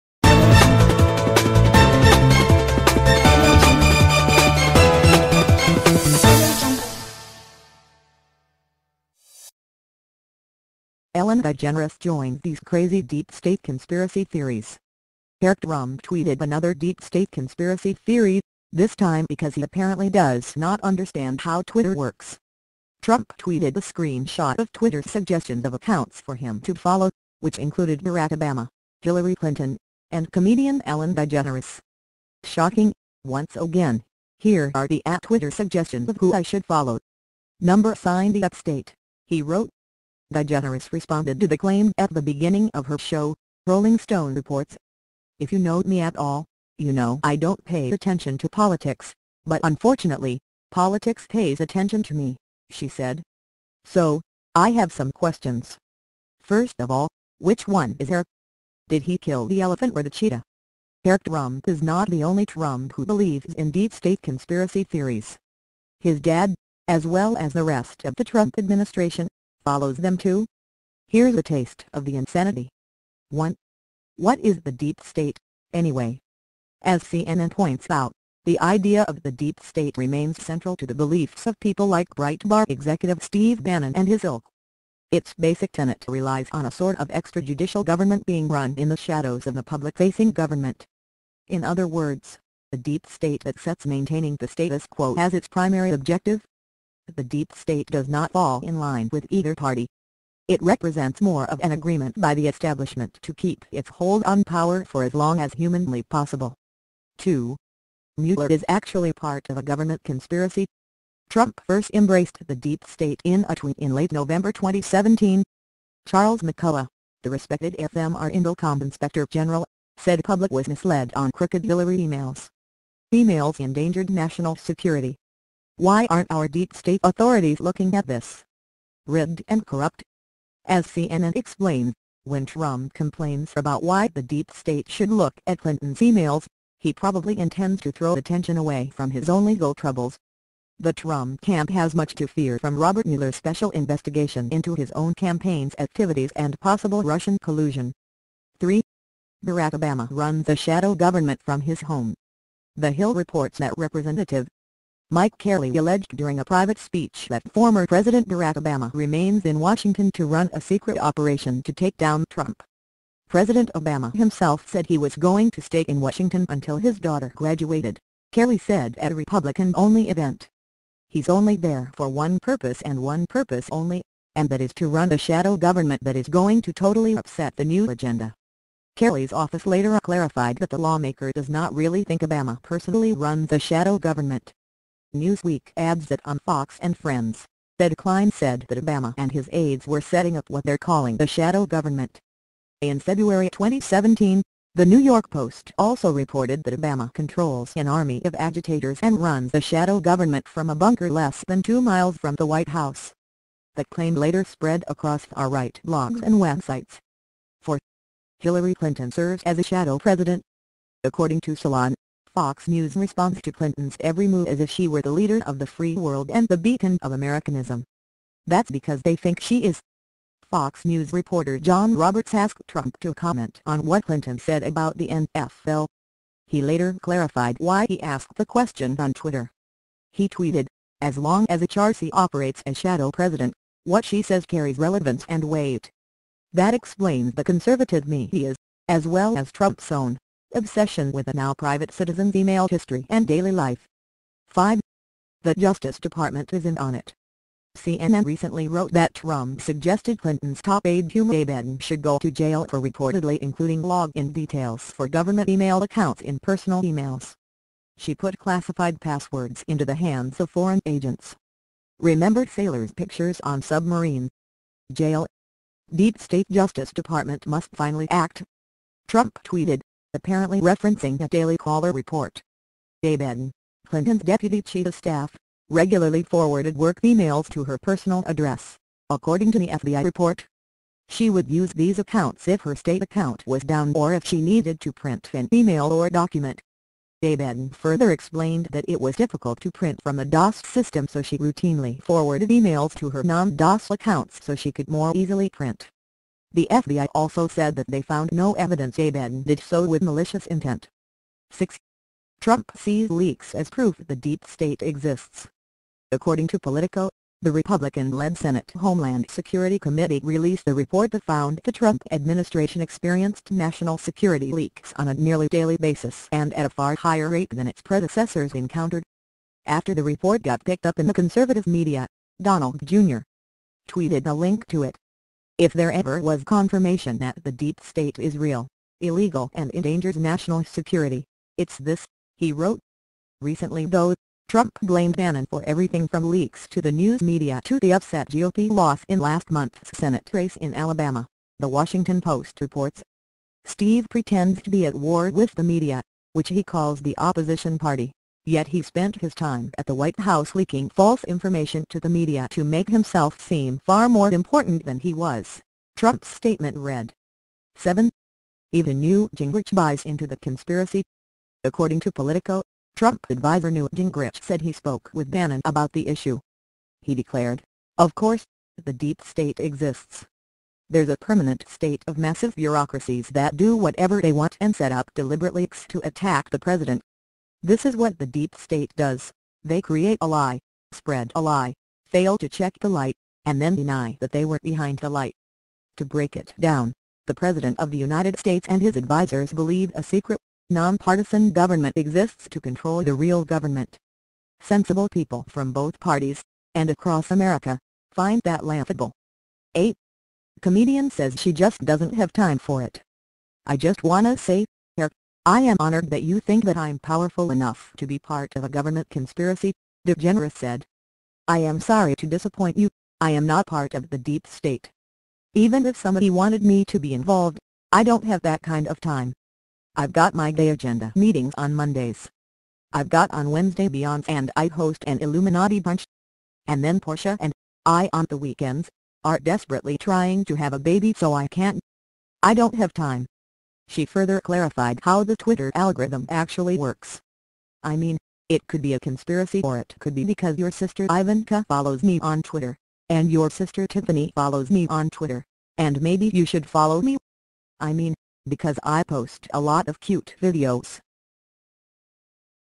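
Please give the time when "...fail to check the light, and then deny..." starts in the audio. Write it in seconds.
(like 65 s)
382 s.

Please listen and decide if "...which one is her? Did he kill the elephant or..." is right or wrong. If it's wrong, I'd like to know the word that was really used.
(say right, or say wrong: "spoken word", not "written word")
right.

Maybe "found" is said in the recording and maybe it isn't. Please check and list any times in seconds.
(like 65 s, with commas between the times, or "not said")
298 s, 311 s.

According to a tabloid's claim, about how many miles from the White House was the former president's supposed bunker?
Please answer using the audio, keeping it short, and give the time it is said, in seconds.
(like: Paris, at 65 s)
2, at 201 s.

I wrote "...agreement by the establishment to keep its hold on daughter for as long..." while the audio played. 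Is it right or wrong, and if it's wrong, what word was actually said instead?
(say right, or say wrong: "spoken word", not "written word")
wrong: "power", not "daughter".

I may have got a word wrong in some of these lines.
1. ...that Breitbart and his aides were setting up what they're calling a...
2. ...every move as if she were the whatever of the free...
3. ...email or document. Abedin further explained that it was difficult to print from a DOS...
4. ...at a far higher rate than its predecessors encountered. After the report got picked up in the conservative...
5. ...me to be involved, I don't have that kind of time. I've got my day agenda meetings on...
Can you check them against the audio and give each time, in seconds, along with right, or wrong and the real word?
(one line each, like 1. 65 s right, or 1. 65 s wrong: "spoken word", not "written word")
1. 188 s wrong: "Obama", not "Breitbart"
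2. 213 s wrong: "leader", not "whatever"
3. 285 s right
4. 316 s right
5. 416 s right.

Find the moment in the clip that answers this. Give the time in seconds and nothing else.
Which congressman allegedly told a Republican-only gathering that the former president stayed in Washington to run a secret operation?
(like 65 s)
155 s.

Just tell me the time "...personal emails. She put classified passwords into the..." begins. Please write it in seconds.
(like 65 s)
256 s.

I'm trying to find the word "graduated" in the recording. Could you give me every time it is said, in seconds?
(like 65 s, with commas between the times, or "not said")
167 s.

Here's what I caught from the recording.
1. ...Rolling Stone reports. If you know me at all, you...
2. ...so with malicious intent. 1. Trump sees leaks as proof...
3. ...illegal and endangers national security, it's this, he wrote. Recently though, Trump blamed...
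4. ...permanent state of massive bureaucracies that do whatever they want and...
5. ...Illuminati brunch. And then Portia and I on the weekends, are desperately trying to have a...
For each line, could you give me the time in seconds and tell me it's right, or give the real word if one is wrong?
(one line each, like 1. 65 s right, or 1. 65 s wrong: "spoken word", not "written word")
1. 43 s right
2. 299 s wrong: "6", not "1"
3. 328 s right
4. 371 s right
5. 425 s right.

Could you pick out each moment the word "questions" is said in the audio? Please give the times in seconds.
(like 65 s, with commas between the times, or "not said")
55 s, 228 s.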